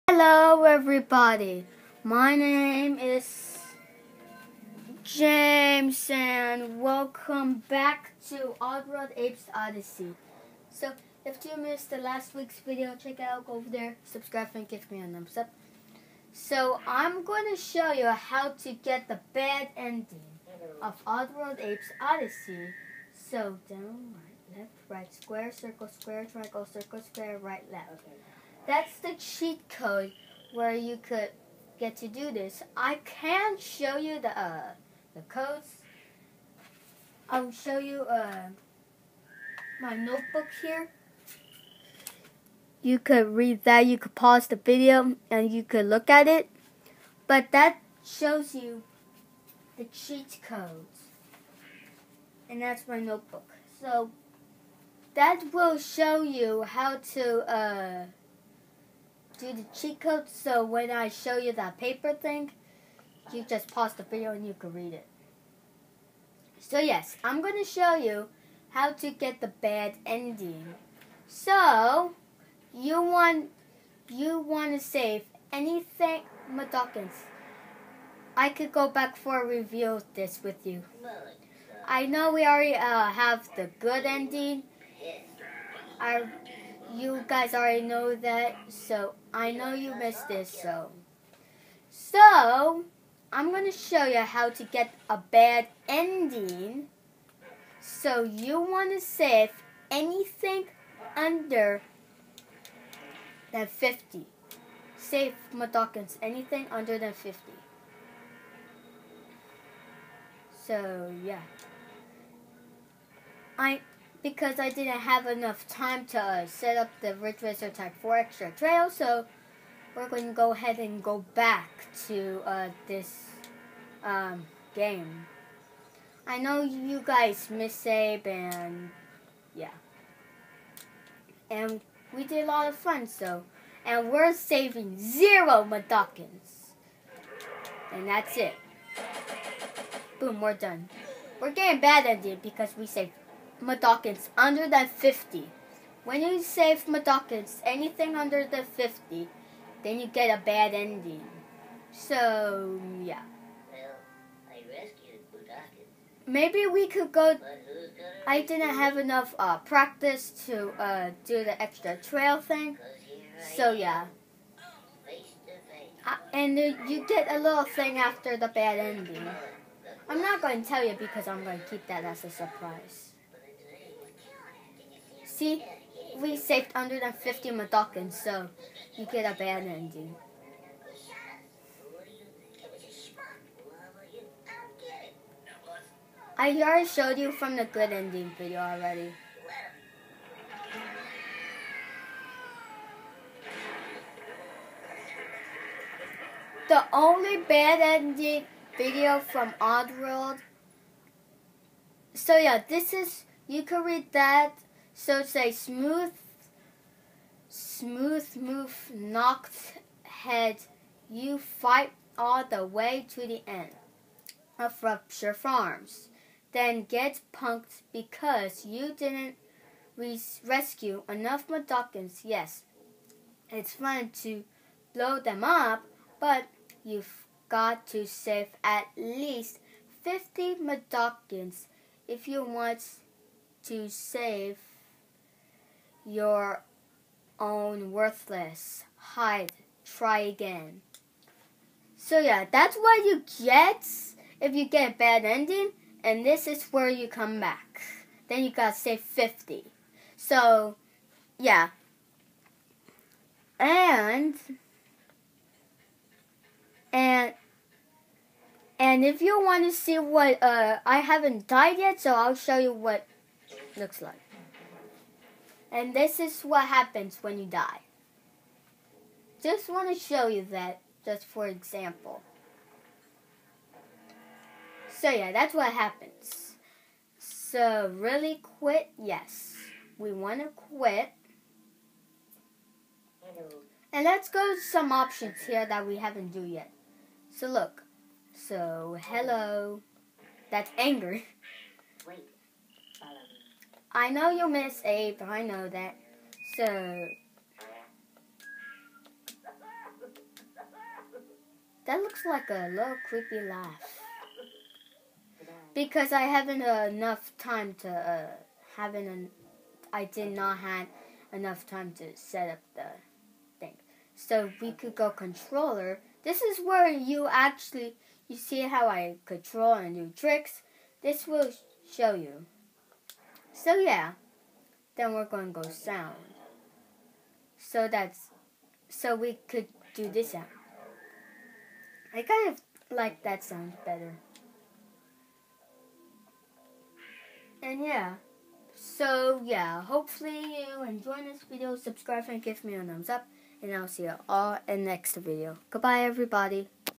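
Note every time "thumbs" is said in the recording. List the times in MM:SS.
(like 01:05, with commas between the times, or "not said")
00:15, 05:42.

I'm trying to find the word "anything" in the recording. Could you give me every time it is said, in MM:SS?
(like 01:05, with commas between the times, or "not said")
01:15, 01:39, 01:46, 02:27.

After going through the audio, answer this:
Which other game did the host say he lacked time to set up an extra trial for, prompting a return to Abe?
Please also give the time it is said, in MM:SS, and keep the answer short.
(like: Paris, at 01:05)
Ridge Racer Type 4, at 01:57.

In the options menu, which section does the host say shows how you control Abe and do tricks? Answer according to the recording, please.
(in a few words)
controller.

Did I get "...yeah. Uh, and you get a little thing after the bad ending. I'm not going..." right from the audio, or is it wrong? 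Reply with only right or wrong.
right.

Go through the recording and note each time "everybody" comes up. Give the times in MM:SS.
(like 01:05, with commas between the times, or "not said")
00:00, 05:46.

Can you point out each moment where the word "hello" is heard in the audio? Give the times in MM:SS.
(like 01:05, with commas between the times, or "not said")
00:00, 04:49.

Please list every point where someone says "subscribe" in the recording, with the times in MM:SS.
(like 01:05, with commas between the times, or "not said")
00:14, 05:41.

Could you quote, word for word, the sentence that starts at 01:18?
I could go back for a review of this with you.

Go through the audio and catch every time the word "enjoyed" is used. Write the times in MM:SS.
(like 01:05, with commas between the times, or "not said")
05:40.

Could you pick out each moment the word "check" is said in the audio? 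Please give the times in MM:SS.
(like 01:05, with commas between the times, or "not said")
00:13.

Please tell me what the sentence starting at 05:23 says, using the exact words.
So yeah, then we're going to go sound.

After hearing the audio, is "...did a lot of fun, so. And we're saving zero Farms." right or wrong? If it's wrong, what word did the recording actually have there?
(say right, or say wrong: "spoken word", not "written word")
wrong: "Mudokons", not "Farms".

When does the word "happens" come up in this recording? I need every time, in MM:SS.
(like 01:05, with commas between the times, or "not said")
04:26, 04:35.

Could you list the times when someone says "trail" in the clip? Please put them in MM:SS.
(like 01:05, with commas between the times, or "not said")
01:58, 02:41.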